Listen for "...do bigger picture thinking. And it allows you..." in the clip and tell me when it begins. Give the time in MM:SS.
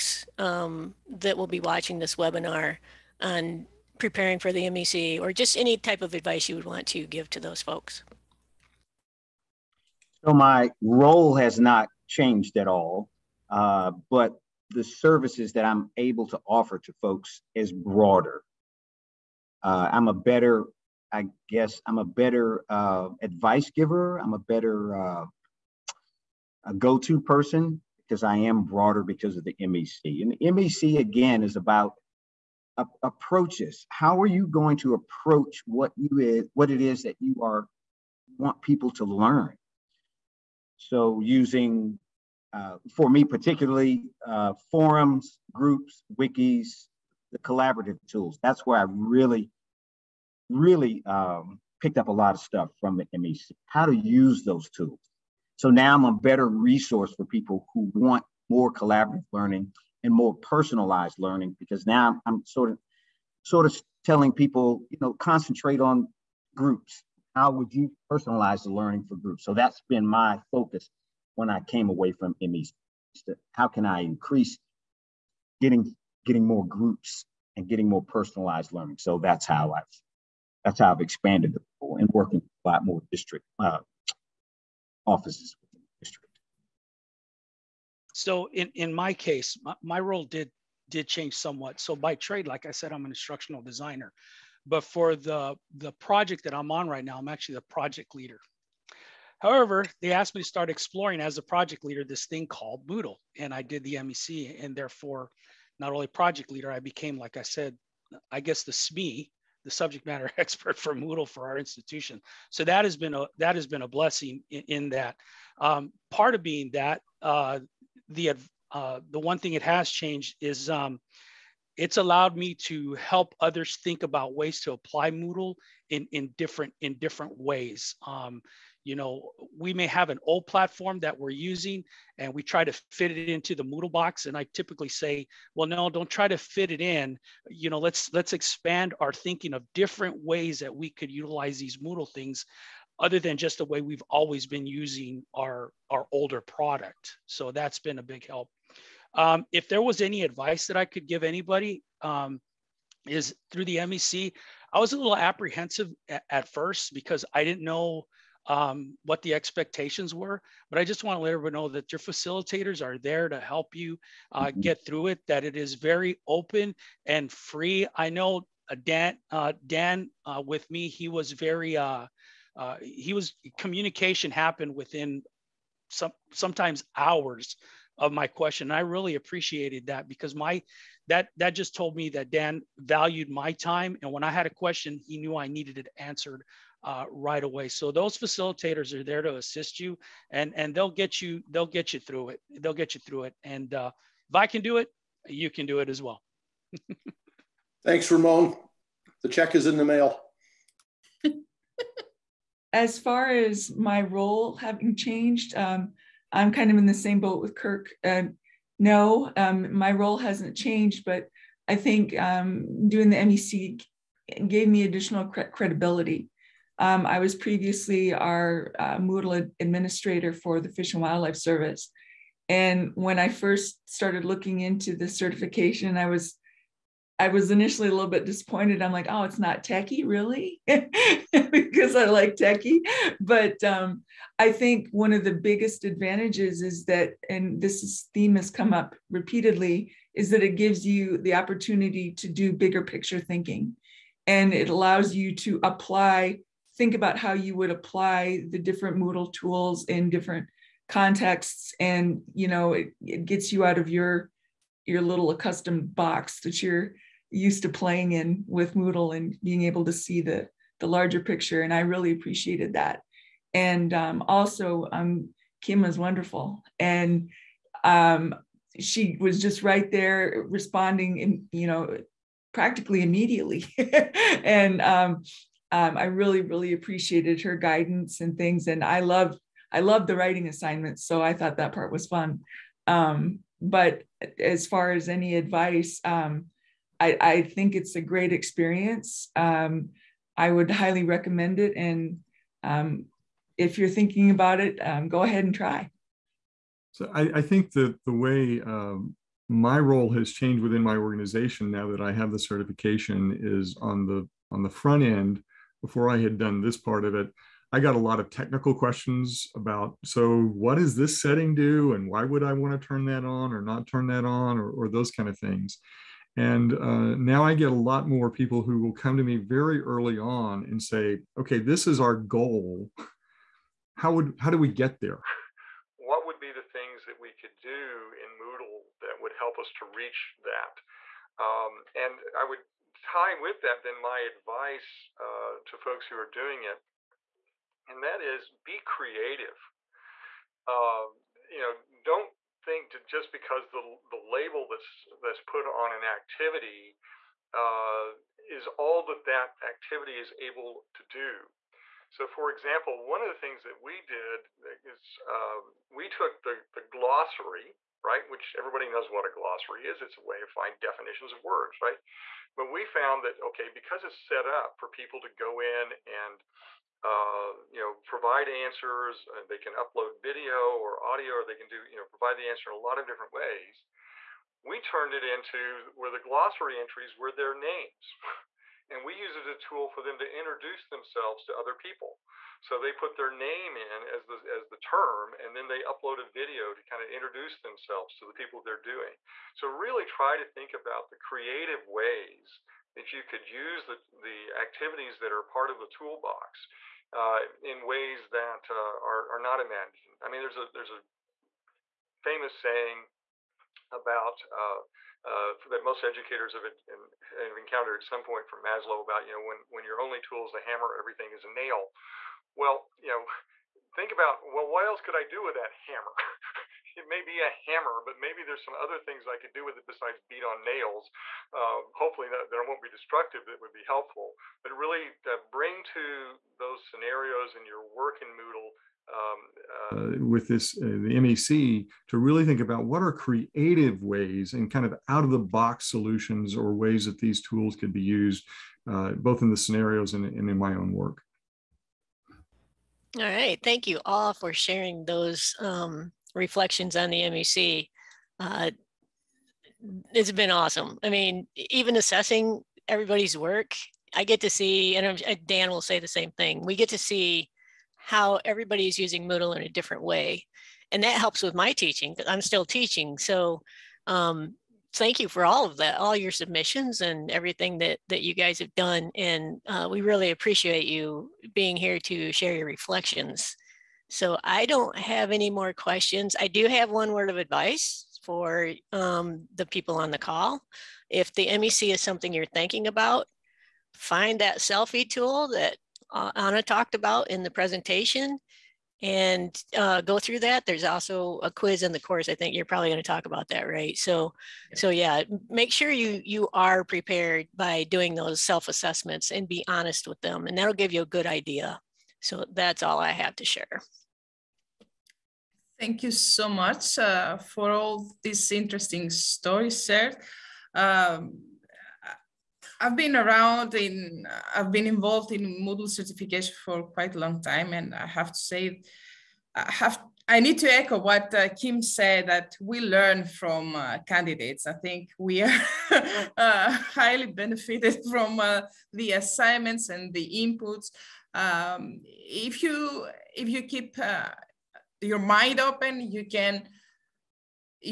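04:02.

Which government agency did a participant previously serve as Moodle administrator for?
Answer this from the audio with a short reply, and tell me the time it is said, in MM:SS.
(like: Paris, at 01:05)
Fish and Wildlife Service, at 03:40.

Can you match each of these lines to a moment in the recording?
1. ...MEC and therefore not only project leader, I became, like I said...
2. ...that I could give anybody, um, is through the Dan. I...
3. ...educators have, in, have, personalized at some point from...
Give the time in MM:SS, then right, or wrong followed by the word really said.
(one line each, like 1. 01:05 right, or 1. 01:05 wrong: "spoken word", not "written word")
1. 01:43 right
2. 02:30 wrong: "MEC", not "Dan"
3. 06:46 wrong: "encountered", not "personalized".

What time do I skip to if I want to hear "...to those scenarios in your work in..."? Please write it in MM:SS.
07:05.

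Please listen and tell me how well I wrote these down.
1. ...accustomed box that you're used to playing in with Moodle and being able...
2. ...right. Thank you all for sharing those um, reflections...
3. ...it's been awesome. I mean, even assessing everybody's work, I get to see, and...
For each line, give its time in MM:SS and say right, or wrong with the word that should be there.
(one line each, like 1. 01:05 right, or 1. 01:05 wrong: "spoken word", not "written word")
1. 04:15 right
2. 07:23 right
3. 07:30 right.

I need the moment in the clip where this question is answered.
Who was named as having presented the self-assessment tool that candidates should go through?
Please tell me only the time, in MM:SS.
08:06.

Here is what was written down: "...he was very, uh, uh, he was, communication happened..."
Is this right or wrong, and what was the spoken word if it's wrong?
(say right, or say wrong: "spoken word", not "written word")
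right.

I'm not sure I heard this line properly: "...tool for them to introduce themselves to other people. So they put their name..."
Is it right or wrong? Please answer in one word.
right.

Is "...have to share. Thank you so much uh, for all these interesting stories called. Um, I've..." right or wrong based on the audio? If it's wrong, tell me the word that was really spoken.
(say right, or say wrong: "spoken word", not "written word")
wrong: "shared", not "called".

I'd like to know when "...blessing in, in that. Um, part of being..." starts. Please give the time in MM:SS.
01:53.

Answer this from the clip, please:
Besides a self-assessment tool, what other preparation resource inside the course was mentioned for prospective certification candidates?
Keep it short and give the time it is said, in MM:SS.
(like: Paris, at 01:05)
a quiz, at 08:11.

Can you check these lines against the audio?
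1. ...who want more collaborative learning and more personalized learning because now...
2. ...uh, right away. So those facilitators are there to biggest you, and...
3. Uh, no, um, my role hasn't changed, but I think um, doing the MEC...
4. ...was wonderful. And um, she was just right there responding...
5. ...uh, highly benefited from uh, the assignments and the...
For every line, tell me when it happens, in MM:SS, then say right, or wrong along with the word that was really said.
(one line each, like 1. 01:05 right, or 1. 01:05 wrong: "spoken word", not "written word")
1. 00:57 right
2. 03:06 wrong: "assist", not "biggest"
3. 03:28 right
4. 04:25 right
5. 08:46 right.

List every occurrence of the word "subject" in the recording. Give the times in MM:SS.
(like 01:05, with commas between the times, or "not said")
01:49.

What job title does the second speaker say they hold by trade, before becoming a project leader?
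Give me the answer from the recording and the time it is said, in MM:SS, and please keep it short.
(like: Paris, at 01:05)
instructional designer, at 01:33.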